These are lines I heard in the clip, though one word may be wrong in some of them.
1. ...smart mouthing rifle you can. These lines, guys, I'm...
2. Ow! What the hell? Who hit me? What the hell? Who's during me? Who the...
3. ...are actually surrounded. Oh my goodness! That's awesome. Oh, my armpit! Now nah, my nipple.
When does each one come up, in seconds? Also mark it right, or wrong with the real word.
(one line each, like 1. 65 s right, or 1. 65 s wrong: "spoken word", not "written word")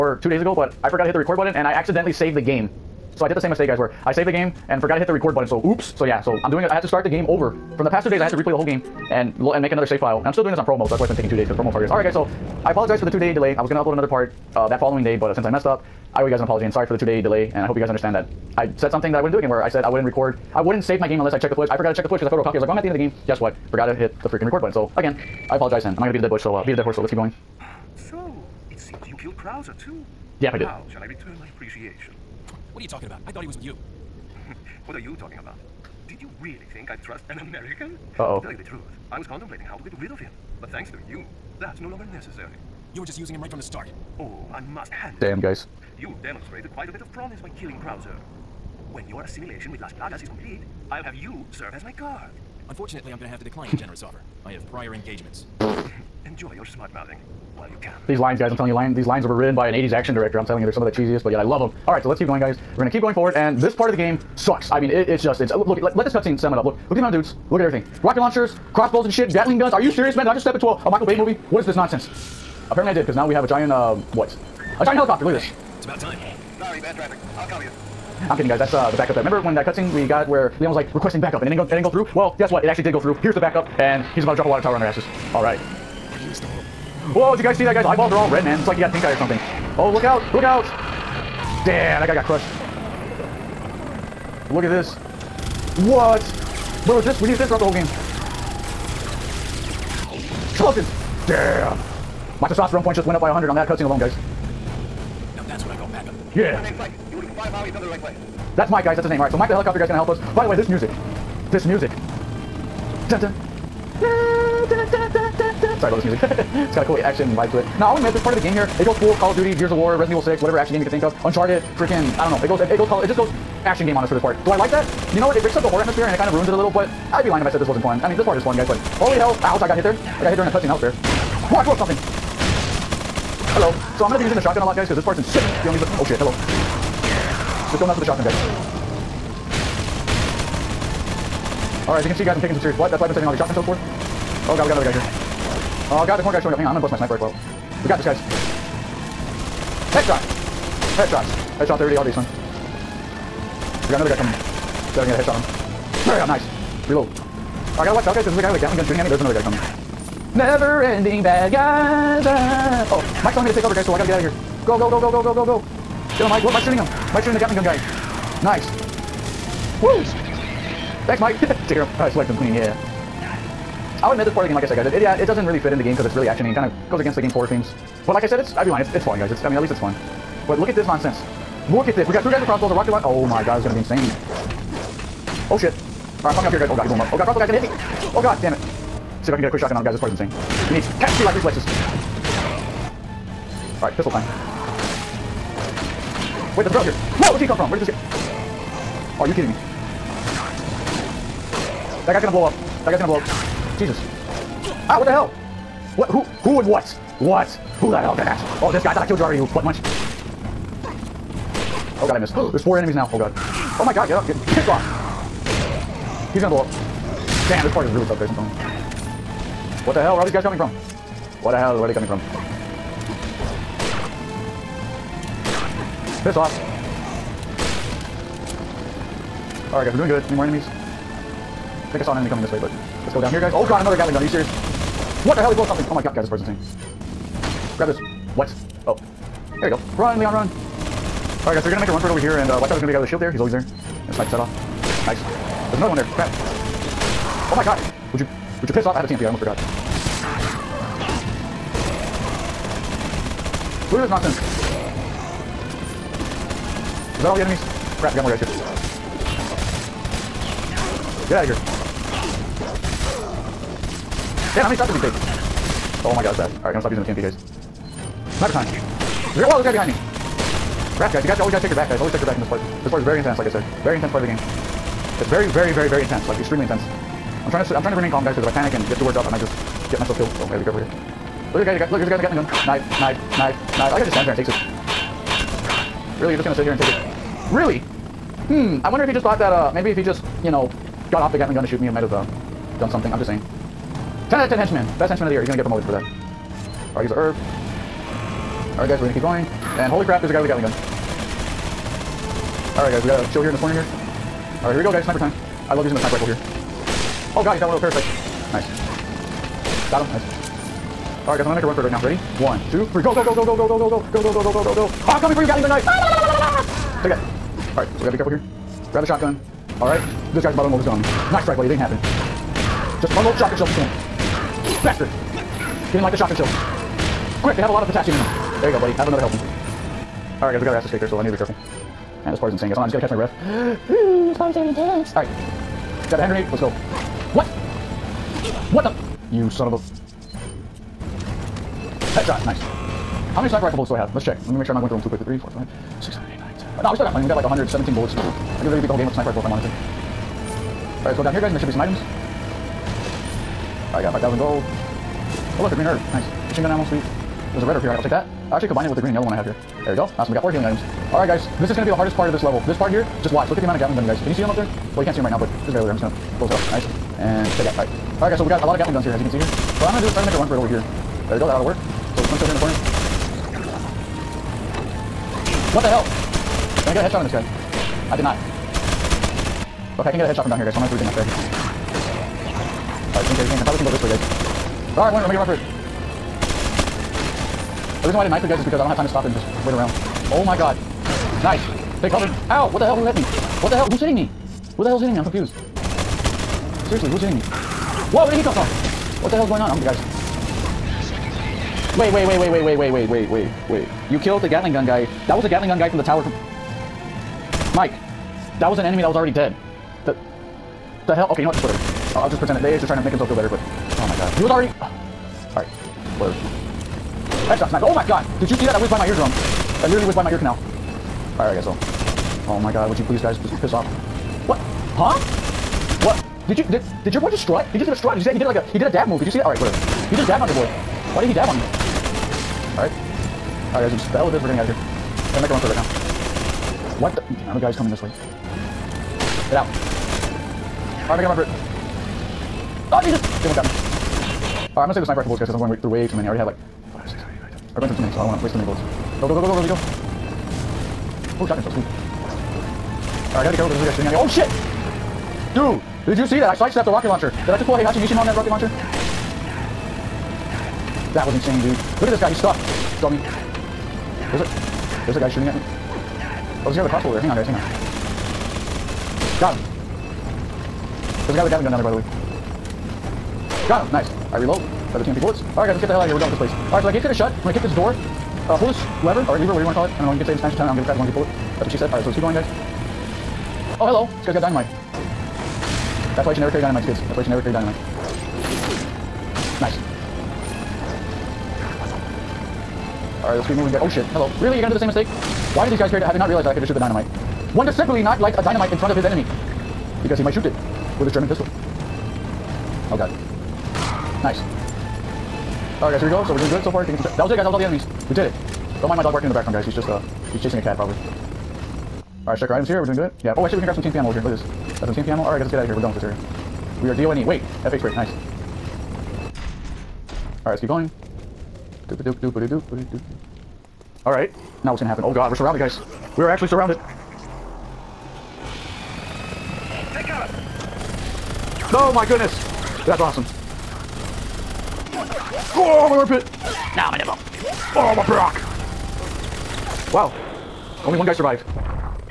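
1. 56 s wrong: "while", not "rifle"
2. 392 s wrong: "hitting", not "during"
3. 526 s right.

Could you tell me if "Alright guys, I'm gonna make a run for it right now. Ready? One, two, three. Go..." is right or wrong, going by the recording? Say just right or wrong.
right.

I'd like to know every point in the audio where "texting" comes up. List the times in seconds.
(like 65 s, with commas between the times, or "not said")
not said.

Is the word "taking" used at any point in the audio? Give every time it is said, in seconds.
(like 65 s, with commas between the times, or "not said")
11 s, 506 s.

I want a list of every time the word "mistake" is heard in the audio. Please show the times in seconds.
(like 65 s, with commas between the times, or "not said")
3 s, 494 s.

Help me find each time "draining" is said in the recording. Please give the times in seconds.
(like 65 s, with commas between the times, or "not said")
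not said.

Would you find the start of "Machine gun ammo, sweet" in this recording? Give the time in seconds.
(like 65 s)
356 s.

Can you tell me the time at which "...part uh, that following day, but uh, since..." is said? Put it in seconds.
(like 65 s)
14 s.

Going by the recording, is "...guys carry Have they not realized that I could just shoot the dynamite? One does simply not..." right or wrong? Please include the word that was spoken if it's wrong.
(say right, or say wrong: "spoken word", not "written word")
right.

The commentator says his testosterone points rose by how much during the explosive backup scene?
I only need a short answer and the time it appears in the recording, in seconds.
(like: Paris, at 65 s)
100, at 103 s.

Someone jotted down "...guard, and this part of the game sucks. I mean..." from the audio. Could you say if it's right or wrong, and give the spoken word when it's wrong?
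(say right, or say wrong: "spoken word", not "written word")
wrong: "forward", not "guard".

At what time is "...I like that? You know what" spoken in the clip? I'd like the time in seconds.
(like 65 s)
124 s.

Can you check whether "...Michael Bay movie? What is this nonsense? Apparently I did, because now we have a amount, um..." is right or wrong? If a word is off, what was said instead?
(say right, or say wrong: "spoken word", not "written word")
wrong: "giant", not "amount".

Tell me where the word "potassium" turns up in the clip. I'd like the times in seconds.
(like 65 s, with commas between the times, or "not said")
327 s.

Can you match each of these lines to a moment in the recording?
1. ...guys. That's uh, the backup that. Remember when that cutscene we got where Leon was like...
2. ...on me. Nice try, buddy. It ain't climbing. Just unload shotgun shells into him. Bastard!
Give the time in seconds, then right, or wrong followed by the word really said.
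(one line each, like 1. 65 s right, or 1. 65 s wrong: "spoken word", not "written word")
1. 78 s right
2. 320 s wrong: "happening", not "climbing".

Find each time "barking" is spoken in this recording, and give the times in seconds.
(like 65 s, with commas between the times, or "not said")
509 s.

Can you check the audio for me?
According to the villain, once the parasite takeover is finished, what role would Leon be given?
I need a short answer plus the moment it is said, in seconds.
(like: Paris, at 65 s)
Guard, at 51 s.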